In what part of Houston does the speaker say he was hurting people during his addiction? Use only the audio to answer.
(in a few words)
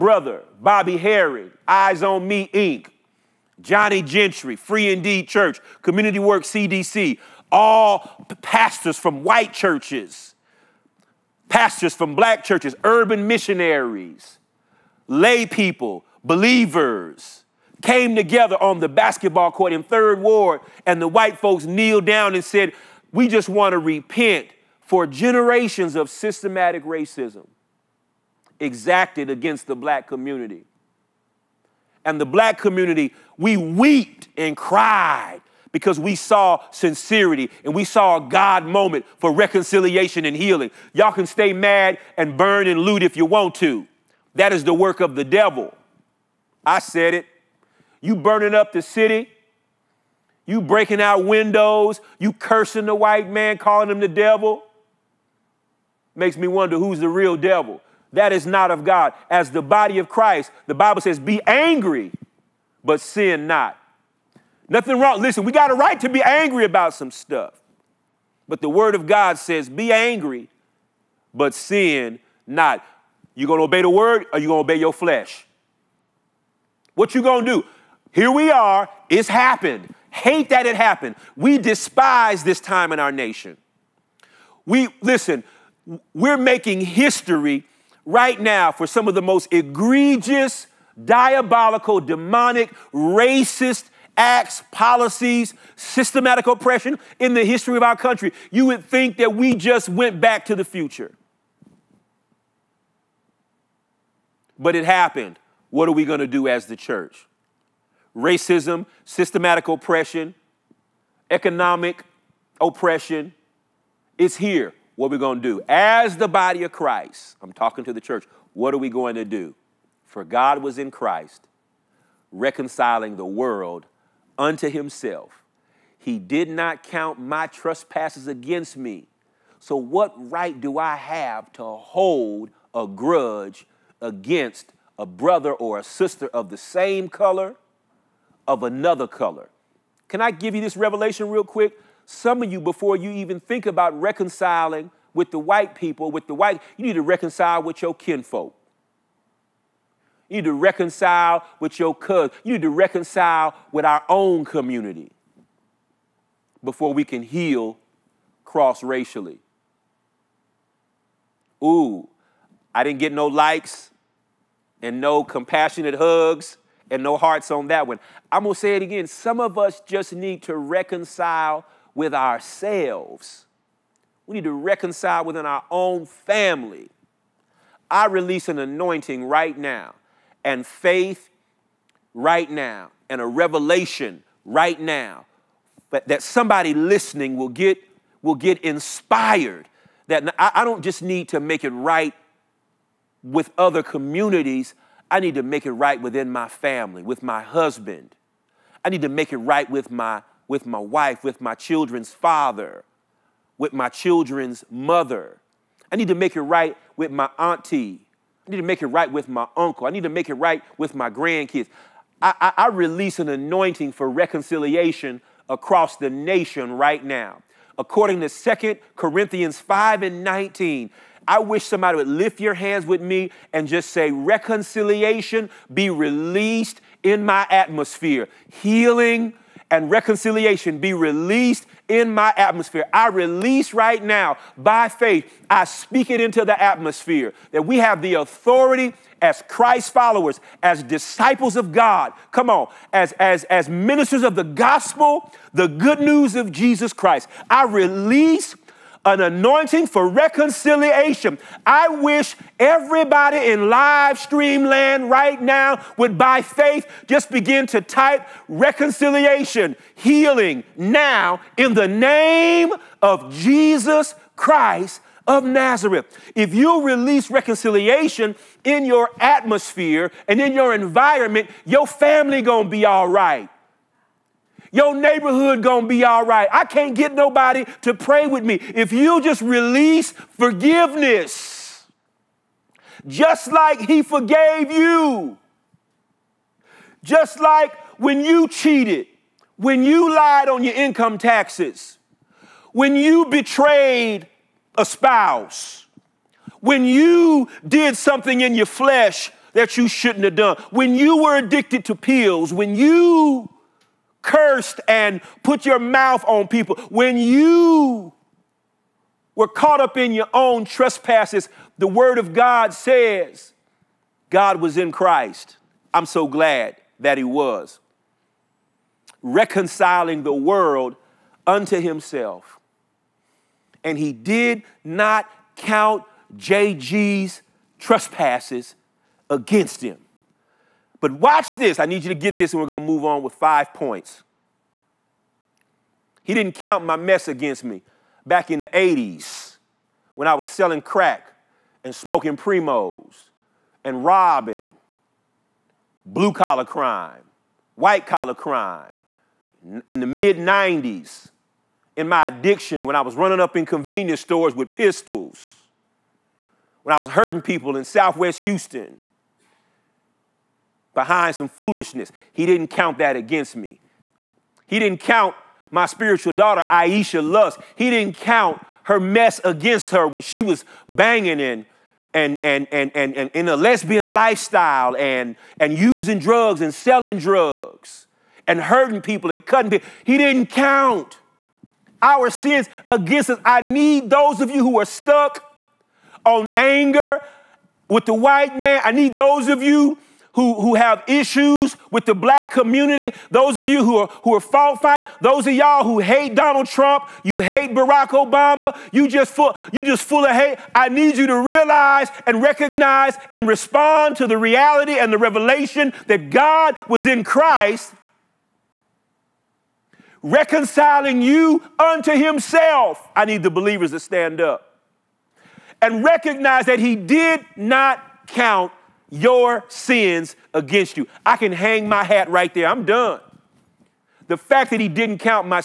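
Southwest Houston.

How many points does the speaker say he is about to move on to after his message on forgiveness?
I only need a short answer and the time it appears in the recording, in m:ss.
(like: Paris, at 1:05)
5, at 5:33.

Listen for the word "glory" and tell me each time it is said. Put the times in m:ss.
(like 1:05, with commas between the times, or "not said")
not said.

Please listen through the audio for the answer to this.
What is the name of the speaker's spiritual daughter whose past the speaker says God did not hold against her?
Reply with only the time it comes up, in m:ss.
6:06.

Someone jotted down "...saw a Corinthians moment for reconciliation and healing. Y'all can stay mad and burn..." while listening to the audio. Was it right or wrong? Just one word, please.
wrong.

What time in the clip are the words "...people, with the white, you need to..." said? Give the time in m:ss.
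2:25.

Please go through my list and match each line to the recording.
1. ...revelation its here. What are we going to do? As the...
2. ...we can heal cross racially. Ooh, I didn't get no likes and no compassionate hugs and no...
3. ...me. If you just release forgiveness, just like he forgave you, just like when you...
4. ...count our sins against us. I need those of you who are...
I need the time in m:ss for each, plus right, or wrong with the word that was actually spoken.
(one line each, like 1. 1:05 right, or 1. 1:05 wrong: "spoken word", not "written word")
1. 1:52 wrong: "oppression", not "revelation"
2. 2:36 right
3. 4:38 right
4. 6:20 right.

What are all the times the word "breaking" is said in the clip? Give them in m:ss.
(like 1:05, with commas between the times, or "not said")
0:50.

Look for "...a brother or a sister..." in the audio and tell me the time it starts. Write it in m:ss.
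2:14.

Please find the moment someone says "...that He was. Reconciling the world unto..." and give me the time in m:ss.
5:16.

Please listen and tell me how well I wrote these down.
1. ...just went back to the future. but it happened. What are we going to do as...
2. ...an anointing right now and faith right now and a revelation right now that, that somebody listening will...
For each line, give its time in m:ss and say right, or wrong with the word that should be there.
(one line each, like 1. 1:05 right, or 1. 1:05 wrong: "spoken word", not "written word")
1. 1:39 right
2. 2:58 right.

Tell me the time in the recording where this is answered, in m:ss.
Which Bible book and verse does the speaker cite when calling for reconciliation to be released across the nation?
3:38.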